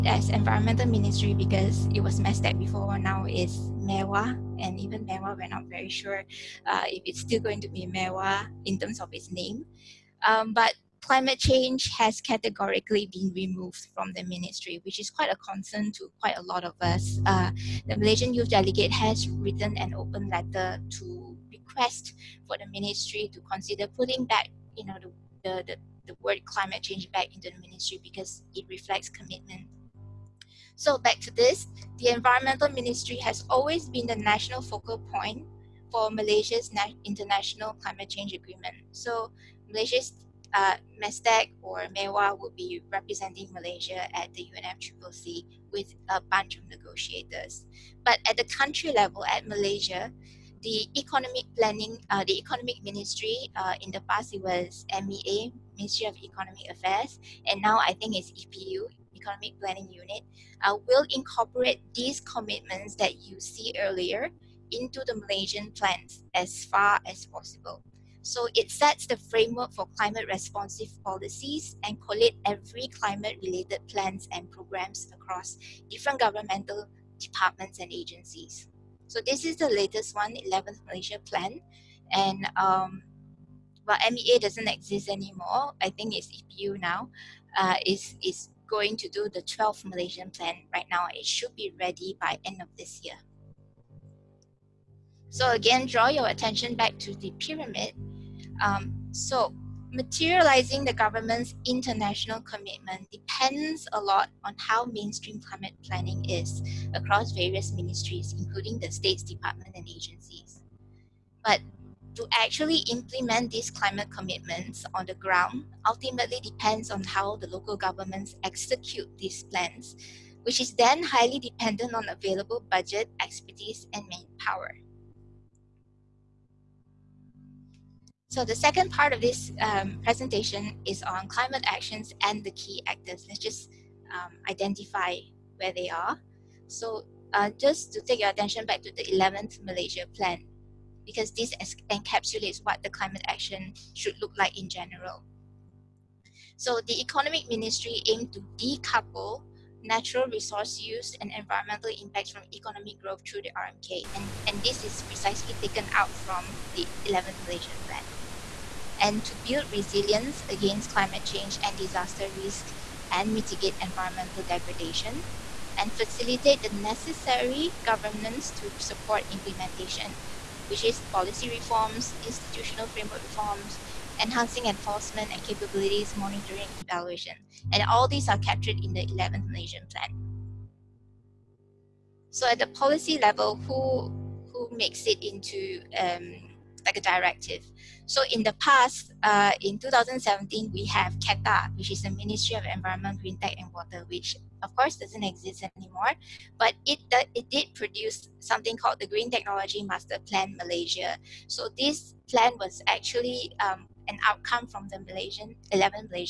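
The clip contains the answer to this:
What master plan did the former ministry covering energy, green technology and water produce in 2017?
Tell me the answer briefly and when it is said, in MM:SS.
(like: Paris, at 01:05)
Green Technology Master Plan Malaysia, at 03:19.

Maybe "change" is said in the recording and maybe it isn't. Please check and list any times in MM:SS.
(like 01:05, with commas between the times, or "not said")
00:11, 00:26, 00:38, 02:41.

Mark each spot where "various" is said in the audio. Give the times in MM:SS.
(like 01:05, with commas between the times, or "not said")
01:47.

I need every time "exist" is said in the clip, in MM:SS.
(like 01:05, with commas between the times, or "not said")
01:24, 03:15.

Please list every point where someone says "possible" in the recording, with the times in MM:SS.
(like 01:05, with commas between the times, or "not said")
01:07.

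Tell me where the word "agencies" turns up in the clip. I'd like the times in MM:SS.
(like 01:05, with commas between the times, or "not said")
01:17, 01:49.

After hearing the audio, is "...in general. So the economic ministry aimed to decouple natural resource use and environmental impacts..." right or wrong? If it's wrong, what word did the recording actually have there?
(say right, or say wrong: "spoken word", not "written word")
right.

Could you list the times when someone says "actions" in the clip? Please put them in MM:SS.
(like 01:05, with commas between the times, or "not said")
02:11, 02:23.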